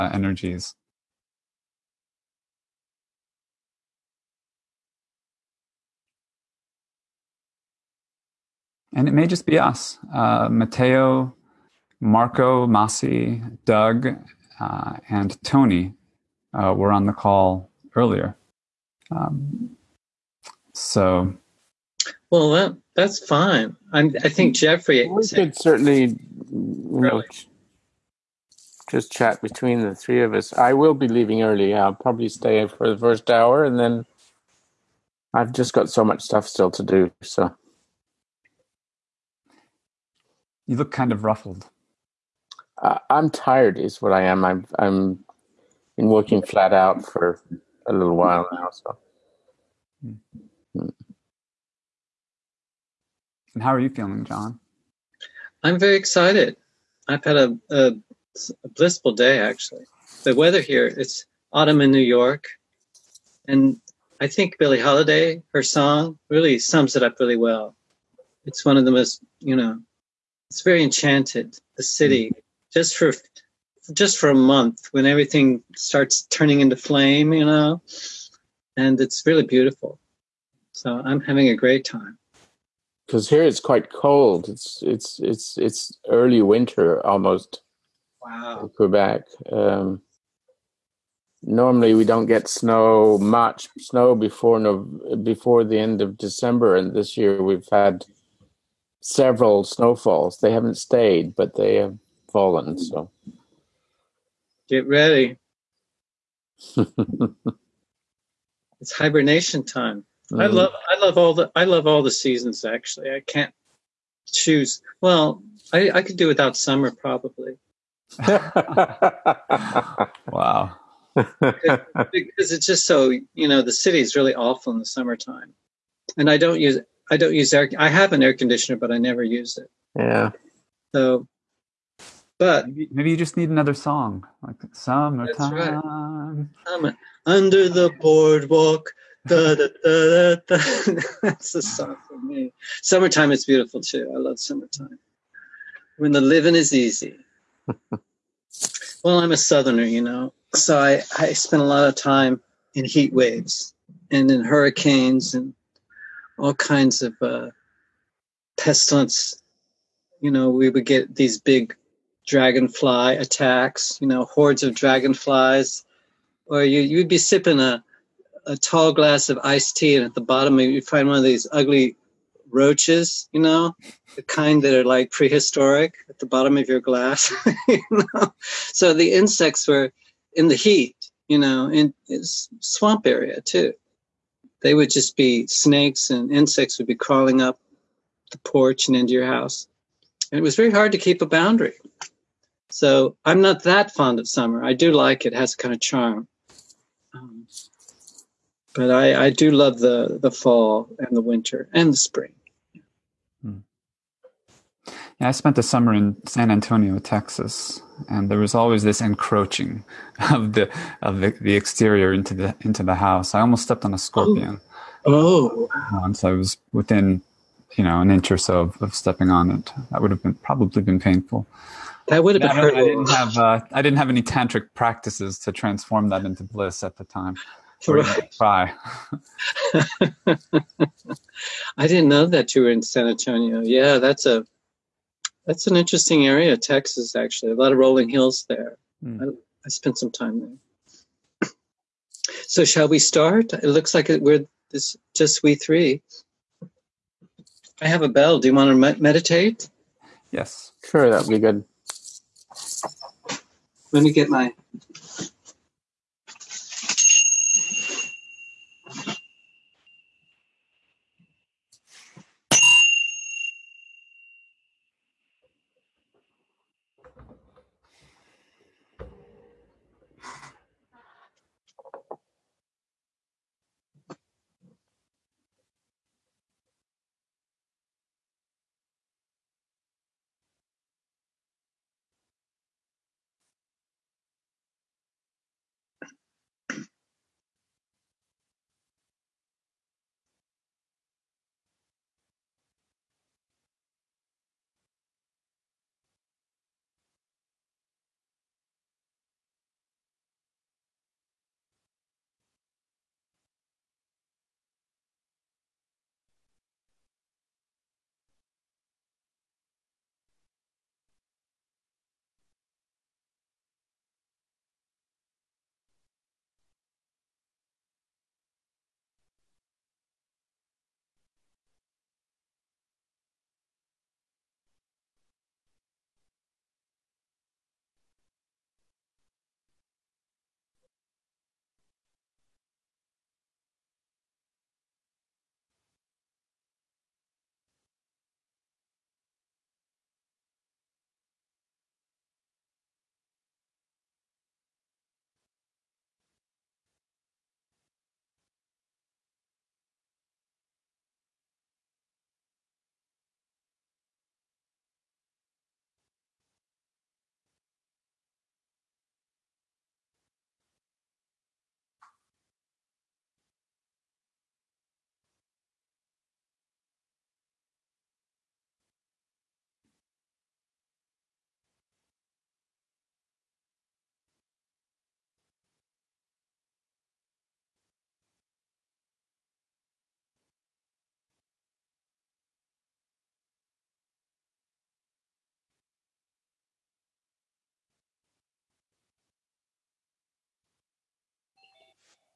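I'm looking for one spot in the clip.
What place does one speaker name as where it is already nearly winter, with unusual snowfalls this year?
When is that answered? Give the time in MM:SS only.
01:28.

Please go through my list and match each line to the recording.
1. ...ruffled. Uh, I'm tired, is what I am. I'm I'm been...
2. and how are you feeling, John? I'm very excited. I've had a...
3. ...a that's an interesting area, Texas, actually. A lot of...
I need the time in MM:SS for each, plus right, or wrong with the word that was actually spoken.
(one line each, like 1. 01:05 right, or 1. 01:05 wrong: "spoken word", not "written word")
1. 00:41 right
2. 00:53 right
3. 03:54 right.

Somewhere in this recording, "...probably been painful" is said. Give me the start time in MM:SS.
03:40.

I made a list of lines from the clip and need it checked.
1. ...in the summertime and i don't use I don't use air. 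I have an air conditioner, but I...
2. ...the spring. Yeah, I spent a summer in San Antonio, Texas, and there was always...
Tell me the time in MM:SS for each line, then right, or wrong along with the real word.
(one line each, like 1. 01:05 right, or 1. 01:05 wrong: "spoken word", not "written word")
1. 02:04 right
2. 03:21 right.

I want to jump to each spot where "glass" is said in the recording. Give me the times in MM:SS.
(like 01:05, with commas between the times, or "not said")
02:48, 02:56.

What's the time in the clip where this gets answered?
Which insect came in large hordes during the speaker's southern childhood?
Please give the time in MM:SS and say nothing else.
02:42.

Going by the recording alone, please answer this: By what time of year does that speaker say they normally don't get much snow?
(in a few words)
end of December.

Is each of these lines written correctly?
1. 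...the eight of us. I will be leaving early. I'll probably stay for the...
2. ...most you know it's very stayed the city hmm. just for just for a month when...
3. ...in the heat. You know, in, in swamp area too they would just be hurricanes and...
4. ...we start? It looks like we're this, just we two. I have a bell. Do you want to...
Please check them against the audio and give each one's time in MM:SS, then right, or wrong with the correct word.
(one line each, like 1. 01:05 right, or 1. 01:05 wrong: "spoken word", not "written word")
1. 00:29 wrong: "three", not "eight"
2. 01:08 wrong: "enchanted", not "stayed"
3. 03:00 wrong: "snakes", not "hurricanes"
4. 04:02 wrong: "three", not "two".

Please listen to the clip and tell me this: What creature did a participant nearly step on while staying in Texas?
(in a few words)
Scorpion.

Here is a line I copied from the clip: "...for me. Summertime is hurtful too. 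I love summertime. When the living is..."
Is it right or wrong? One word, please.
wrong.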